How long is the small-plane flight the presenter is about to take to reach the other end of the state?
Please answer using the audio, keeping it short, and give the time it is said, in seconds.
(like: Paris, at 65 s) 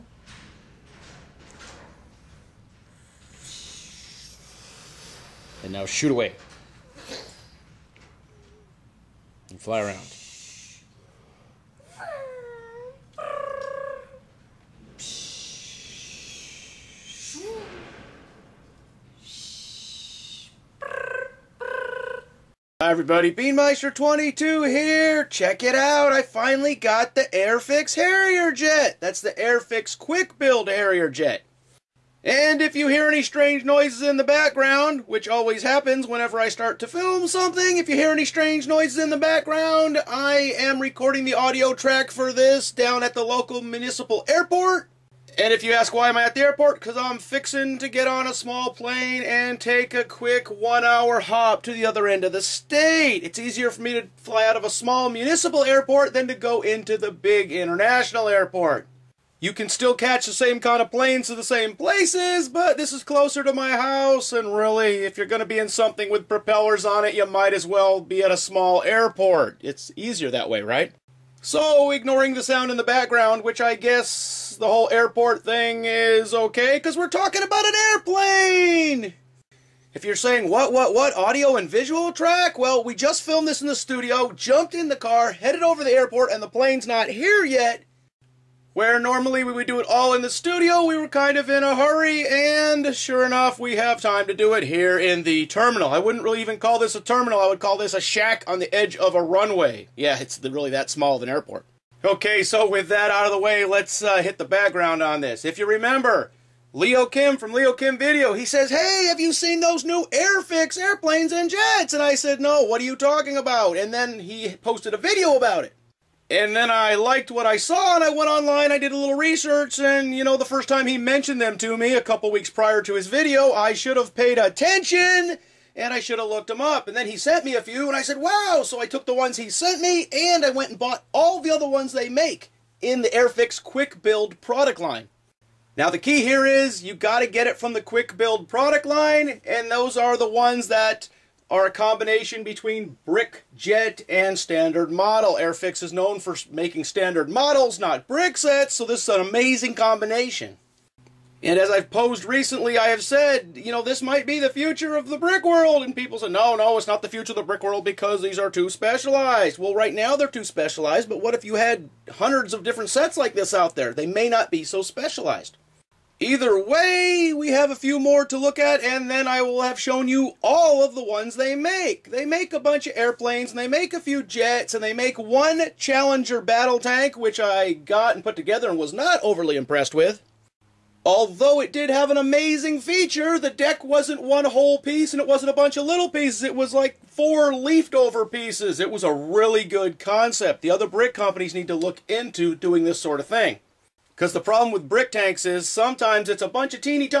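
1 hour, at 50 s.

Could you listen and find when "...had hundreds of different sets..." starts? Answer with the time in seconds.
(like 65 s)
161 s.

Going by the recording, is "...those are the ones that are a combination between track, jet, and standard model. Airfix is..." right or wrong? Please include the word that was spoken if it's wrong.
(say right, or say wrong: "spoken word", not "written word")
wrong: "brick", not "track".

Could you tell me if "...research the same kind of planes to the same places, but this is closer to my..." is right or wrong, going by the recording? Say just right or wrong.
wrong.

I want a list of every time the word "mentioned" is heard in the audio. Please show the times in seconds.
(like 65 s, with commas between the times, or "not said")
120 s.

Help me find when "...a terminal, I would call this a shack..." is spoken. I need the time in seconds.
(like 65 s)
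96 s.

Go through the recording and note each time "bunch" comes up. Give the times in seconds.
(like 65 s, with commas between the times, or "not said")
172 s, 185 s, 196 s.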